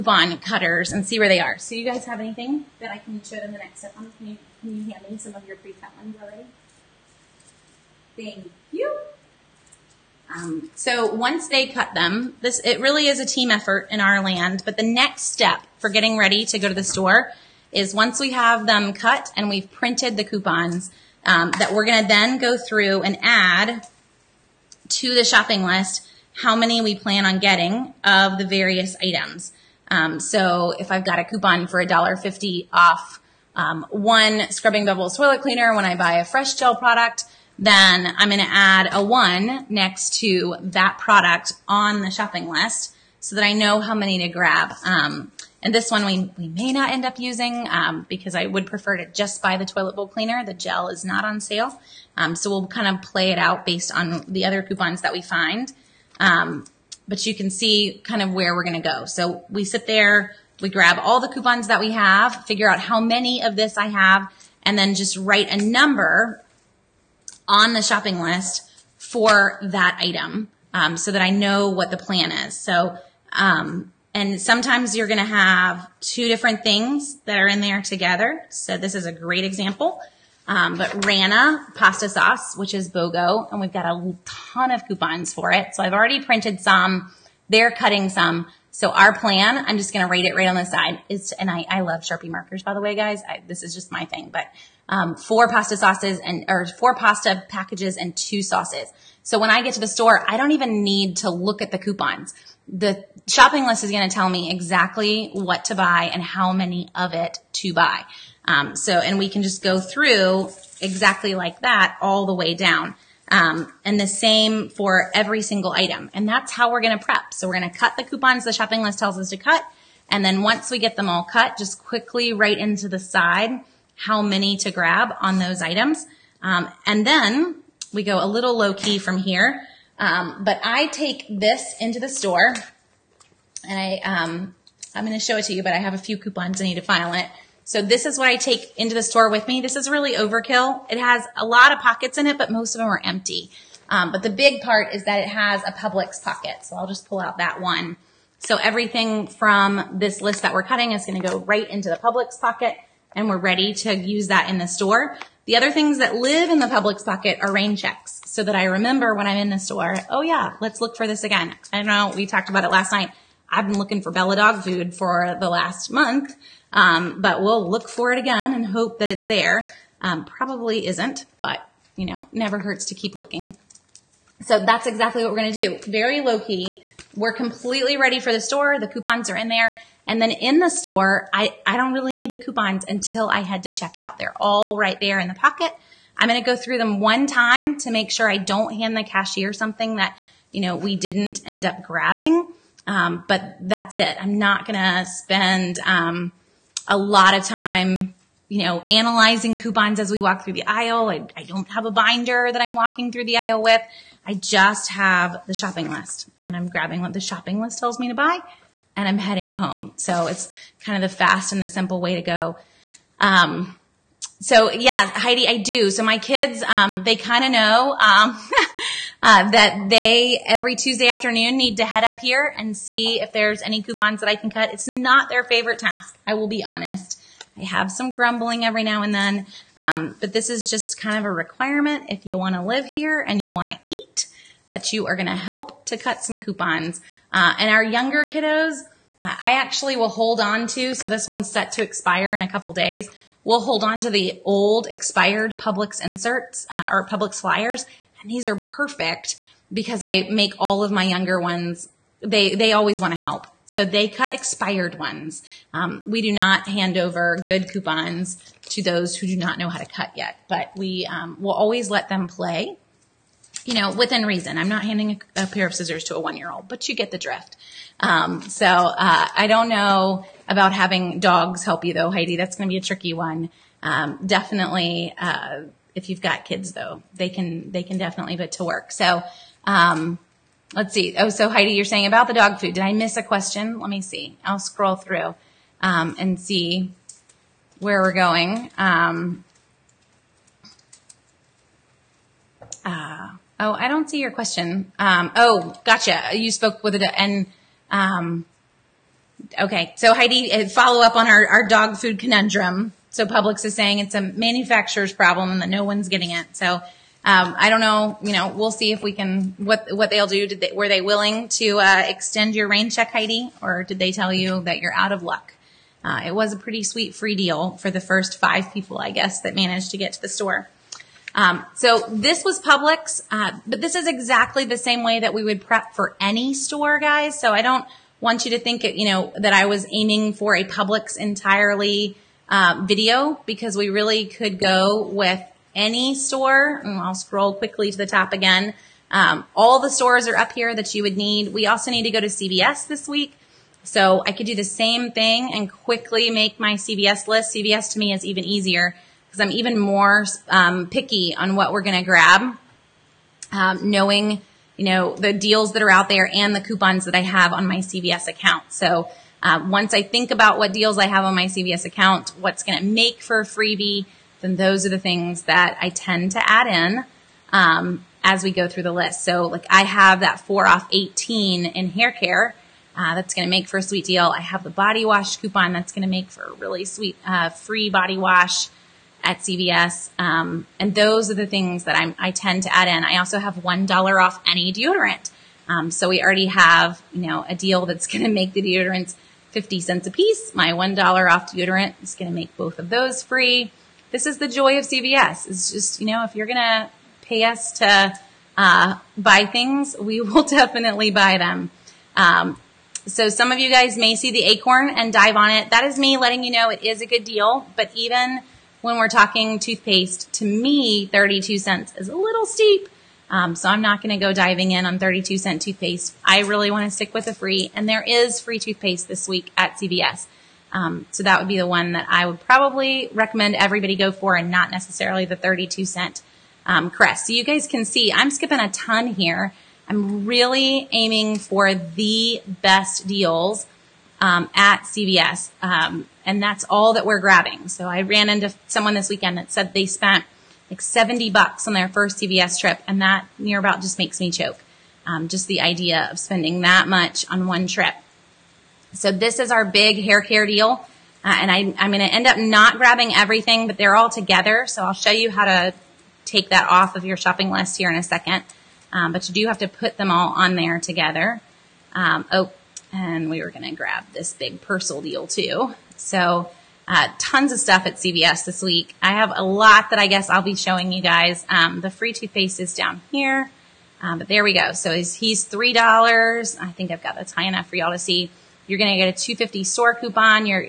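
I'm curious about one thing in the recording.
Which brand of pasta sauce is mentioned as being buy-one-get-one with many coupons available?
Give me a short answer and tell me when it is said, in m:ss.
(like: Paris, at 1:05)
Rana, at 1:21.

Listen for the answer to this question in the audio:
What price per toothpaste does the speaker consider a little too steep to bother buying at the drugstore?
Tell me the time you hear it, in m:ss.
6:51.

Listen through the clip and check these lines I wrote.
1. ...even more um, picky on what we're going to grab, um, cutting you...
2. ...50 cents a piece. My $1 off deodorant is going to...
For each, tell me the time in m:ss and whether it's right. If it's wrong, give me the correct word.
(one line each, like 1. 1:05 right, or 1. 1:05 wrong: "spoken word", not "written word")
1. 5:49 wrong: "knowing", not "cutting"
2. 6:29 right.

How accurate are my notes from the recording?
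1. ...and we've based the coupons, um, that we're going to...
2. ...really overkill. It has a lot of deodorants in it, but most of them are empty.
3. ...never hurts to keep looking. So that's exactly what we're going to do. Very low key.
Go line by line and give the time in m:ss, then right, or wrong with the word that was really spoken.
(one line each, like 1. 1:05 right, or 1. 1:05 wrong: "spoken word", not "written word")
1. 0:19 wrong: "printed", not "based"
2. 2:19 wrong: "pockets", not "deodorants"
3. 2:52 right.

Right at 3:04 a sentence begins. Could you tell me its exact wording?
They're all right there in the pocket.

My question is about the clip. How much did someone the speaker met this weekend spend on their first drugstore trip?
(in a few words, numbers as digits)
$70.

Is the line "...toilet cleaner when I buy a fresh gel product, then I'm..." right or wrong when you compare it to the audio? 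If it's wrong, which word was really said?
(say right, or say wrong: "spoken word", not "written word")
right.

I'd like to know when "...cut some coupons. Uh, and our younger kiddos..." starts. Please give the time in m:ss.
3:55.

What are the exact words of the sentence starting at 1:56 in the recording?
And that's how we're going to prep.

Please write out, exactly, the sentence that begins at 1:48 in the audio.
Um, so, and we can just go through exactly like that all the way down.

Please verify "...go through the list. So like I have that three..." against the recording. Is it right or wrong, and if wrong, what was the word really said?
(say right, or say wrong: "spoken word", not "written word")
wrong: "four", not "three".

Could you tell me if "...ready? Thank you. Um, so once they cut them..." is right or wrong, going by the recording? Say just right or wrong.
wrong.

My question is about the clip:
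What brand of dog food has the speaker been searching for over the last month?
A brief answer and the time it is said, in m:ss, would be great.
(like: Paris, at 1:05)
Bella, at 2:44.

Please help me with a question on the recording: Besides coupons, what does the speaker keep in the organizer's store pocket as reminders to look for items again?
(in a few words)
Rain checks.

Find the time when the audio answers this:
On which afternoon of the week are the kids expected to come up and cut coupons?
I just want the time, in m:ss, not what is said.
3:40.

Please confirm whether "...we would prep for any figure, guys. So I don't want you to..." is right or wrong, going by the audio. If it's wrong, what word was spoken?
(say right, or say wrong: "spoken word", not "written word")
wrong: "store", not "figure".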